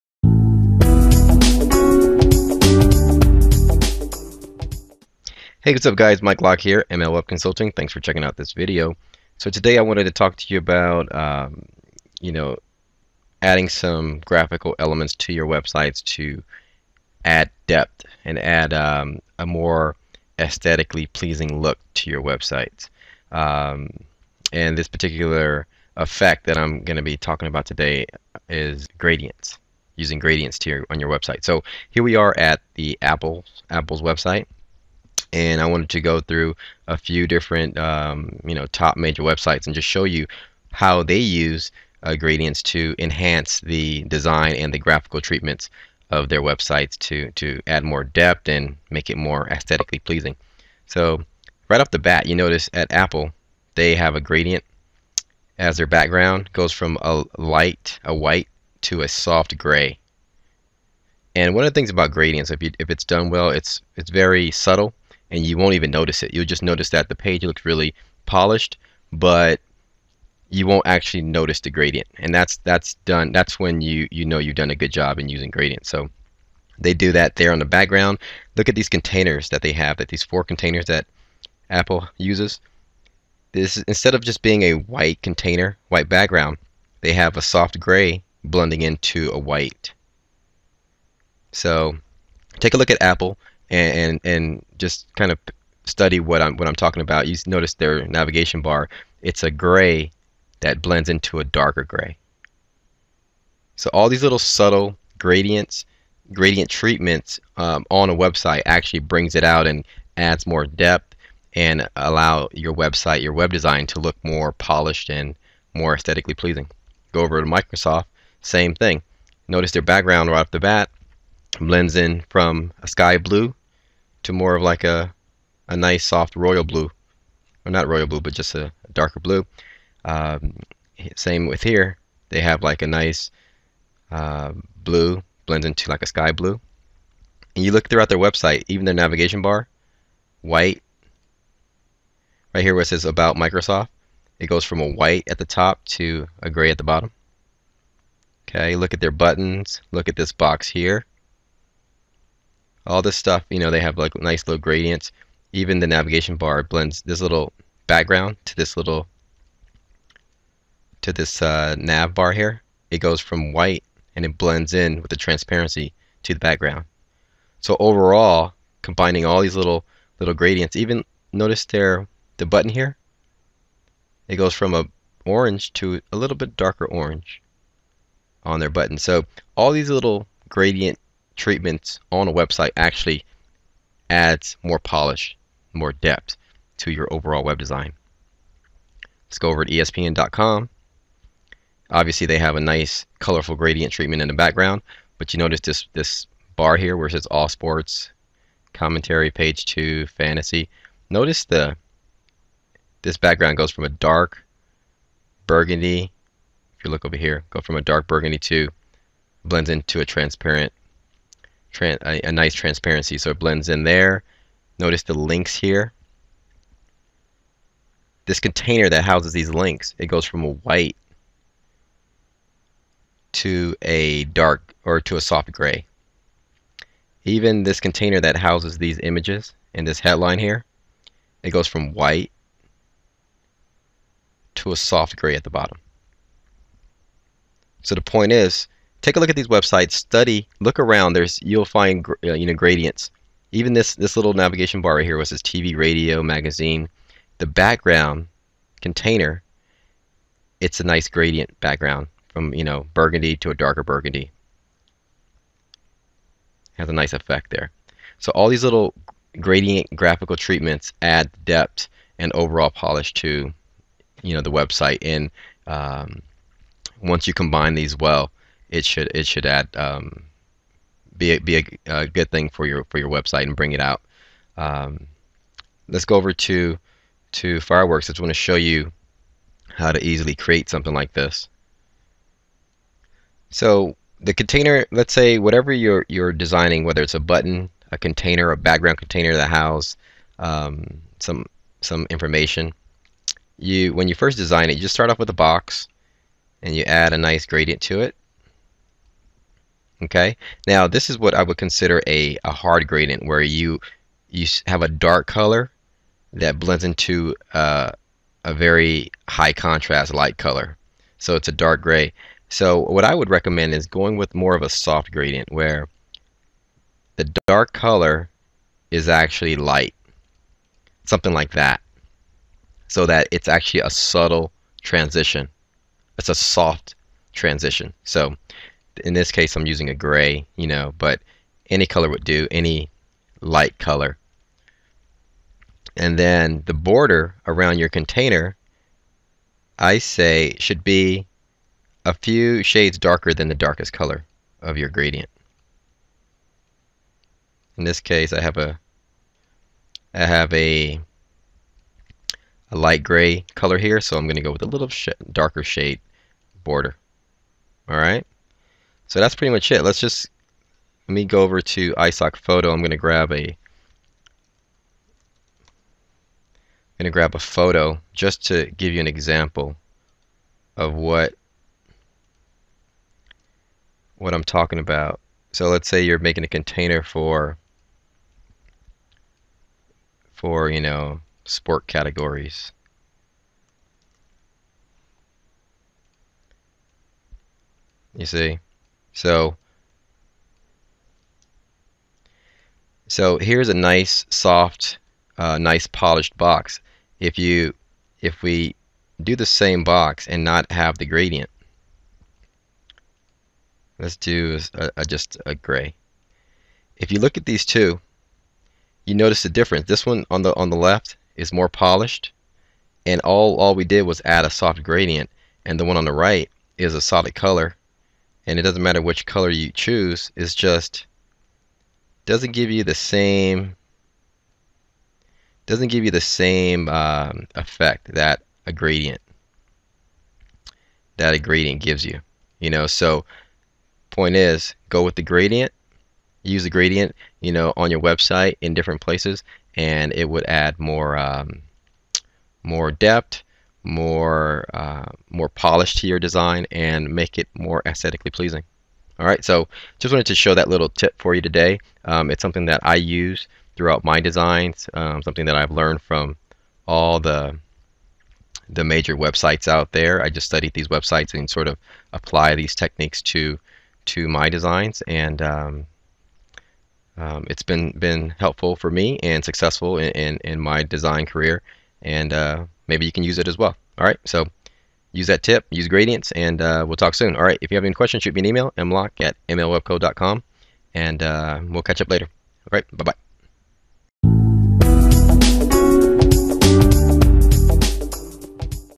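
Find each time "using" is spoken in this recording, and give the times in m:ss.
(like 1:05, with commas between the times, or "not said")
0:29, 1:15, 5:29.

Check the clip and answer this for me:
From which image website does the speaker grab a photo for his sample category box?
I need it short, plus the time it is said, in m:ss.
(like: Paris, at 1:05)
iStockphoto, at 6:01.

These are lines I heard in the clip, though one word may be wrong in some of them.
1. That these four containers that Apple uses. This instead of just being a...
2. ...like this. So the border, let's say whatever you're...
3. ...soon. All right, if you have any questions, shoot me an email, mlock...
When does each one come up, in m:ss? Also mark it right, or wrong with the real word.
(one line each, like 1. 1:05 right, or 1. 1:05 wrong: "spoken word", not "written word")
1. 1:19 right
2. 4:40 wrong: "container", not "border"
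3. 7:57 right.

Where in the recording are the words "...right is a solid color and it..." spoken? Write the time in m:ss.
6:56.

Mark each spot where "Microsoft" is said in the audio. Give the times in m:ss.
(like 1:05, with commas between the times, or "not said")
1:57, 2:23.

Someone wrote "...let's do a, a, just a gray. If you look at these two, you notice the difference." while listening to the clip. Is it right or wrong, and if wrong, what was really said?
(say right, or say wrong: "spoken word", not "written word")
right.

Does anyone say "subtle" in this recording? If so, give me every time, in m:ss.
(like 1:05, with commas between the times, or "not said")
1:04, 1:44, 5:23.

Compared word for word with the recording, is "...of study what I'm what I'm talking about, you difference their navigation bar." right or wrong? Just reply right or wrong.
wrong.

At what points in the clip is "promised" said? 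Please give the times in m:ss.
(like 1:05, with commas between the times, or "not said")
not said.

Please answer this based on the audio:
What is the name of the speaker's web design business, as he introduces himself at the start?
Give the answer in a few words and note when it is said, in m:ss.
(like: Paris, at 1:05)
ML Web Consulting, at 0:06.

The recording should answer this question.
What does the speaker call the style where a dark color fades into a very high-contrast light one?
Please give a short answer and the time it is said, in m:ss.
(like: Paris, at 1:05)
hard gradient, at 5:02.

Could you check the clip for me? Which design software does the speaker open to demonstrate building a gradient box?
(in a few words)
Fireworks.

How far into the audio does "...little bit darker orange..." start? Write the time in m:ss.
2:56.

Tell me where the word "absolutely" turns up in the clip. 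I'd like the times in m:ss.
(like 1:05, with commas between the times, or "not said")
not said.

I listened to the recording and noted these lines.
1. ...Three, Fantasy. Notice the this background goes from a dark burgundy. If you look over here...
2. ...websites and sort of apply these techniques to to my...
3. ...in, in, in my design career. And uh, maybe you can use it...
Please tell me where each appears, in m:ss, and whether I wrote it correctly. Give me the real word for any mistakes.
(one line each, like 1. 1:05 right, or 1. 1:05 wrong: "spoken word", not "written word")
1. 3:19 wrong: "Two", not "Three"
2. 7:40 right
3. 7:49 right.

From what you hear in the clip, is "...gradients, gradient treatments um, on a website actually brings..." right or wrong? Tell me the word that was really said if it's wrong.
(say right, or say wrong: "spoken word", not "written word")
right.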